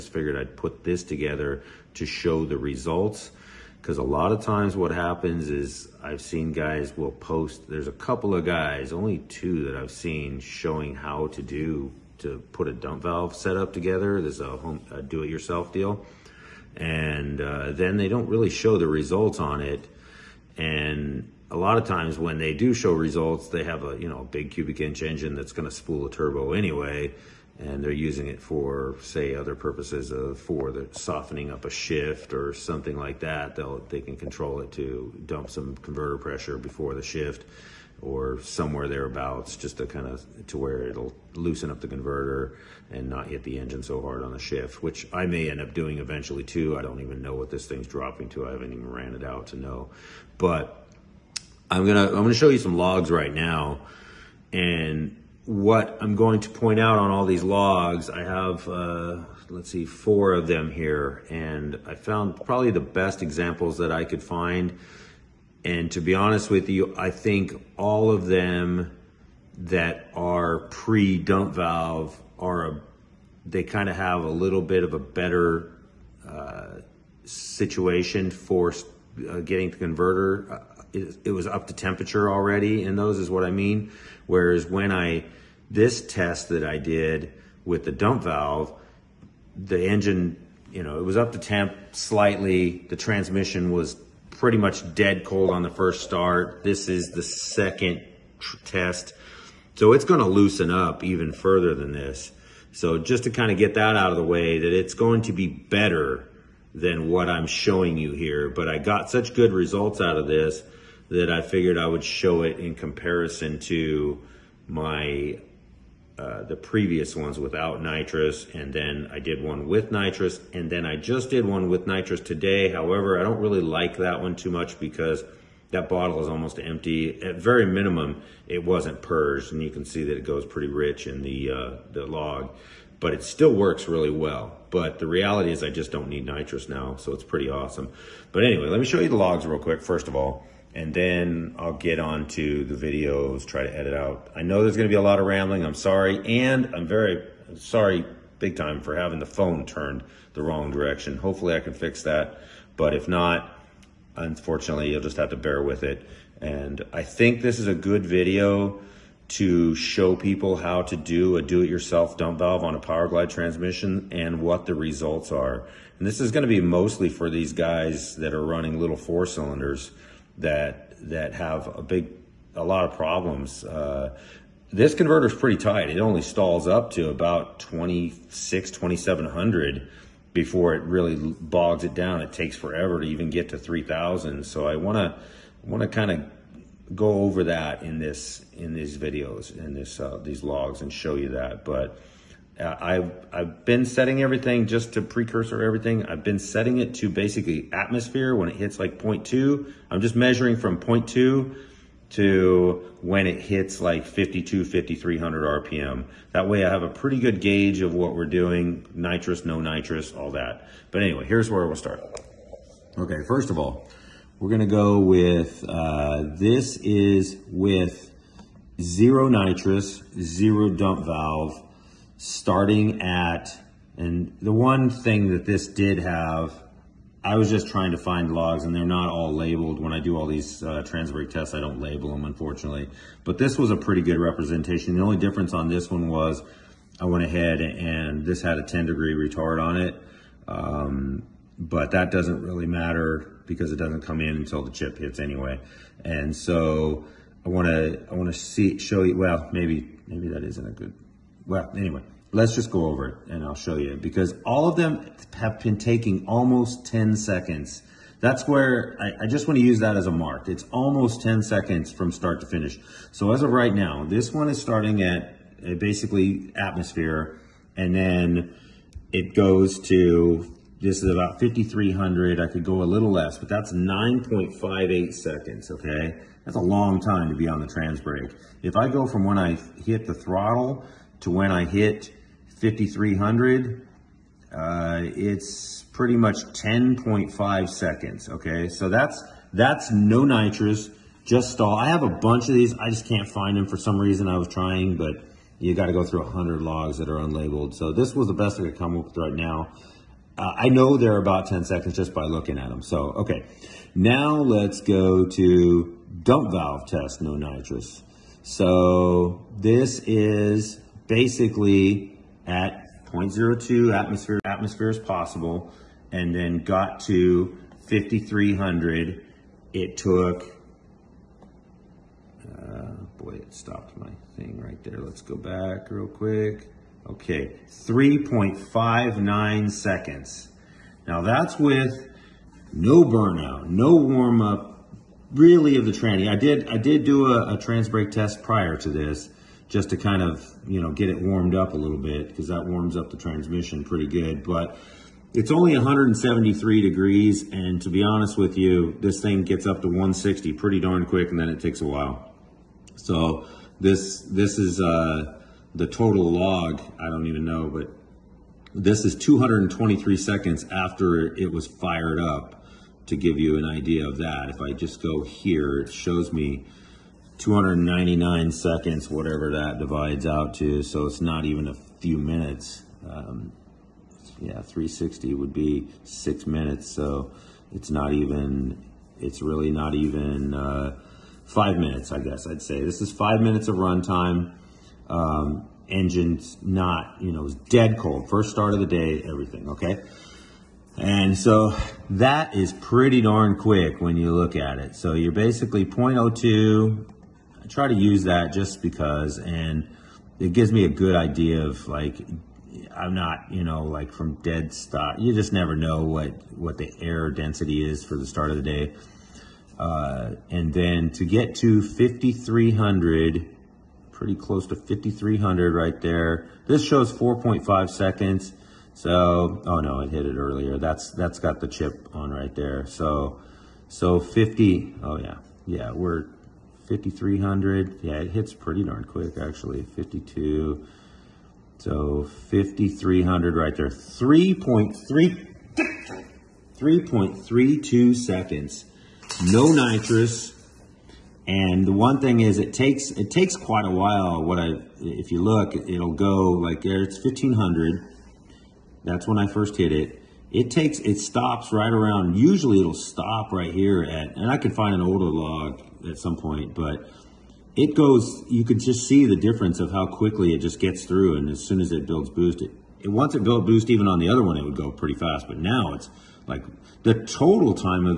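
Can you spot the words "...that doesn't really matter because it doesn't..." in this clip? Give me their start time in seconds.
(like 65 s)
241 s.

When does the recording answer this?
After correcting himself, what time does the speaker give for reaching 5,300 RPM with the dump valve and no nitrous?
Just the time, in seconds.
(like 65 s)
436 s.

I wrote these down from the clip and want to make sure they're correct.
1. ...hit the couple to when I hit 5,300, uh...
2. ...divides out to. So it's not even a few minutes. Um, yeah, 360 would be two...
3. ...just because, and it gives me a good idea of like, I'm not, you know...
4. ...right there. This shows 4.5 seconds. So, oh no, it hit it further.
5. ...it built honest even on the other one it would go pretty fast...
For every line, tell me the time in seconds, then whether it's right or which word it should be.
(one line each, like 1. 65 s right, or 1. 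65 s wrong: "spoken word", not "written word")
1. 279 s wrong: "throttle", not "couple"
2. 369 s wrong: "six", not "two"
3. 398 s right
4. 415 s wrong: "earlier", not "further"
5. 463 s wrong: "boost", not "honest".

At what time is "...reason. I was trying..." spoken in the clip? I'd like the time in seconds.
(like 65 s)
293 s.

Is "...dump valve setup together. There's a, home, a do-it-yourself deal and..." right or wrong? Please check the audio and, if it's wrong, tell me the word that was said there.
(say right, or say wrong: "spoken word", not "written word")
right.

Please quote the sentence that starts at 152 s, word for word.
But if not, unfortunately, you'll just have to bear with it.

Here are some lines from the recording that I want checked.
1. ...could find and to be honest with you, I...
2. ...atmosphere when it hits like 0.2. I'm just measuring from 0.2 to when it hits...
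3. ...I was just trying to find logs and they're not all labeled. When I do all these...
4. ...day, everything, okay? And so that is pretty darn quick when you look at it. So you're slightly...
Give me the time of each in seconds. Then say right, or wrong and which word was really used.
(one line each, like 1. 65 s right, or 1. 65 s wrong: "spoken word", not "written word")
1. 64 s right
2. 197 s right
3. 227 s right
4. 388 s wrong: "basically", not "slightly".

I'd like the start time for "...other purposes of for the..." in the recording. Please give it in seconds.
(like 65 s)
29 s.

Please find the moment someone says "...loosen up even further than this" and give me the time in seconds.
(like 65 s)
100 s.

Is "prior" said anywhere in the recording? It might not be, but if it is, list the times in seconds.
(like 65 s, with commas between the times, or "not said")
338 s.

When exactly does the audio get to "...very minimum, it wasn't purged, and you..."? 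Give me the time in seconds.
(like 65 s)
127 s.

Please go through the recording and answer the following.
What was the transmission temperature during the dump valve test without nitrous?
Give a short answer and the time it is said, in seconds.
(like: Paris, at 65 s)
173 degrees, at 345 s.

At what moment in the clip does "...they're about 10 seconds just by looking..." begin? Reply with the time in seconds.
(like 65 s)
300 s.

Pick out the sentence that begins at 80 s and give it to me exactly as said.
Uh, it, it, was up to temperature already in those is what I mean.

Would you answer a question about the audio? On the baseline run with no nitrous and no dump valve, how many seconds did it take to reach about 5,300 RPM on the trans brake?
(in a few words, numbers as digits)
9.58 seconds.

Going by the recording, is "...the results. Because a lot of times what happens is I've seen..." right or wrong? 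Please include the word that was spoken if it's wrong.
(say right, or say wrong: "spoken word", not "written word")
right.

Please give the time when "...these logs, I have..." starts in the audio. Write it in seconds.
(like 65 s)
57 s.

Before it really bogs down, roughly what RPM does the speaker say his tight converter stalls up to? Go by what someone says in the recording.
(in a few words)
2,700.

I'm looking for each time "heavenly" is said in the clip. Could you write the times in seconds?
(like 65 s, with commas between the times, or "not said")
not said.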